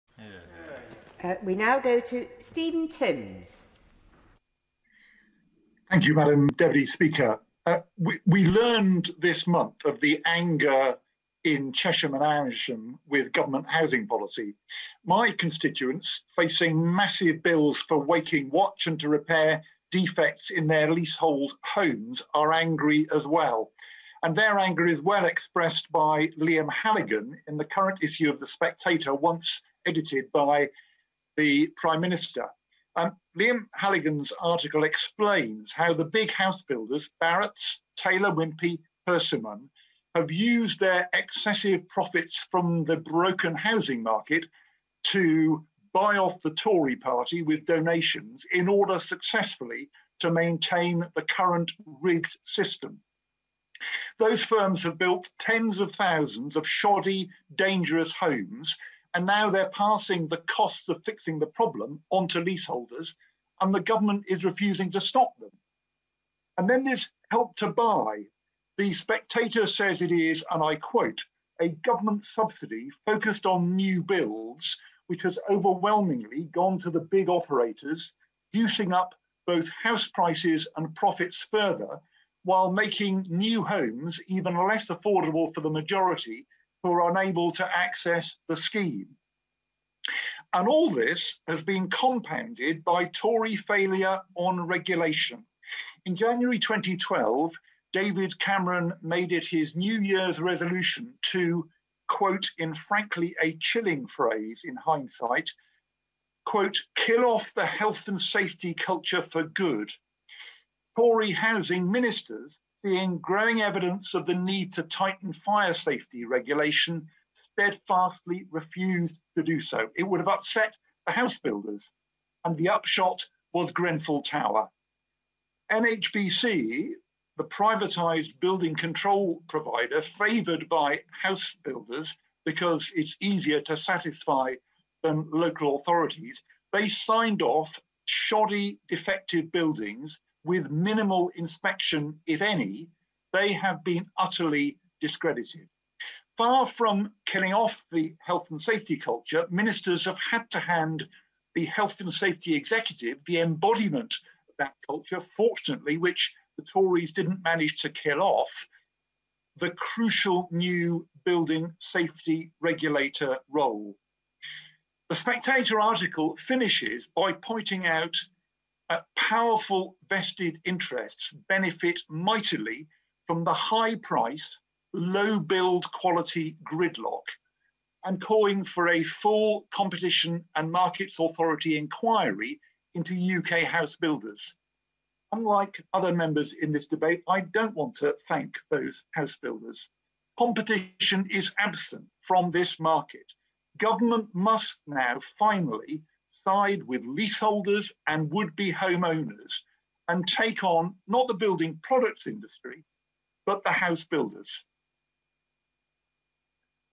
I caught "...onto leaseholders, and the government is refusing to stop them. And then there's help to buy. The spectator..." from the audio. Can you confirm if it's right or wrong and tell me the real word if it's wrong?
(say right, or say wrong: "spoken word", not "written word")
right.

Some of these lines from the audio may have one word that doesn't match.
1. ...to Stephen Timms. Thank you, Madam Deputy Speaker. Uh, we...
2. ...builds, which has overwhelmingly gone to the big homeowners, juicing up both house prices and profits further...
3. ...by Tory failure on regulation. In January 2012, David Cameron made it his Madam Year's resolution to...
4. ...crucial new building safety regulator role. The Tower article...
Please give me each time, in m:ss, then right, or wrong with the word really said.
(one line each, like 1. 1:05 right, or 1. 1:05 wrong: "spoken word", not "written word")
1. 0:01 right
2. 1:14 wrong: "operators", not "homeowners"
3. 1:32 wrong: "New", not "Madam"
4. 2:39 wrong: "Spectator", not "Tower".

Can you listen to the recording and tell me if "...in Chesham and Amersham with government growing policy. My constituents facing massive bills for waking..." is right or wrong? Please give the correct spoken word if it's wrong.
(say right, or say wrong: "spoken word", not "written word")
wrong: "housing", not "growing".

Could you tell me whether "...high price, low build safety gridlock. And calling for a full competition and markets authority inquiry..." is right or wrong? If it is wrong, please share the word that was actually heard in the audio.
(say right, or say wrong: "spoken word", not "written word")
wrong: "quality", not "safety".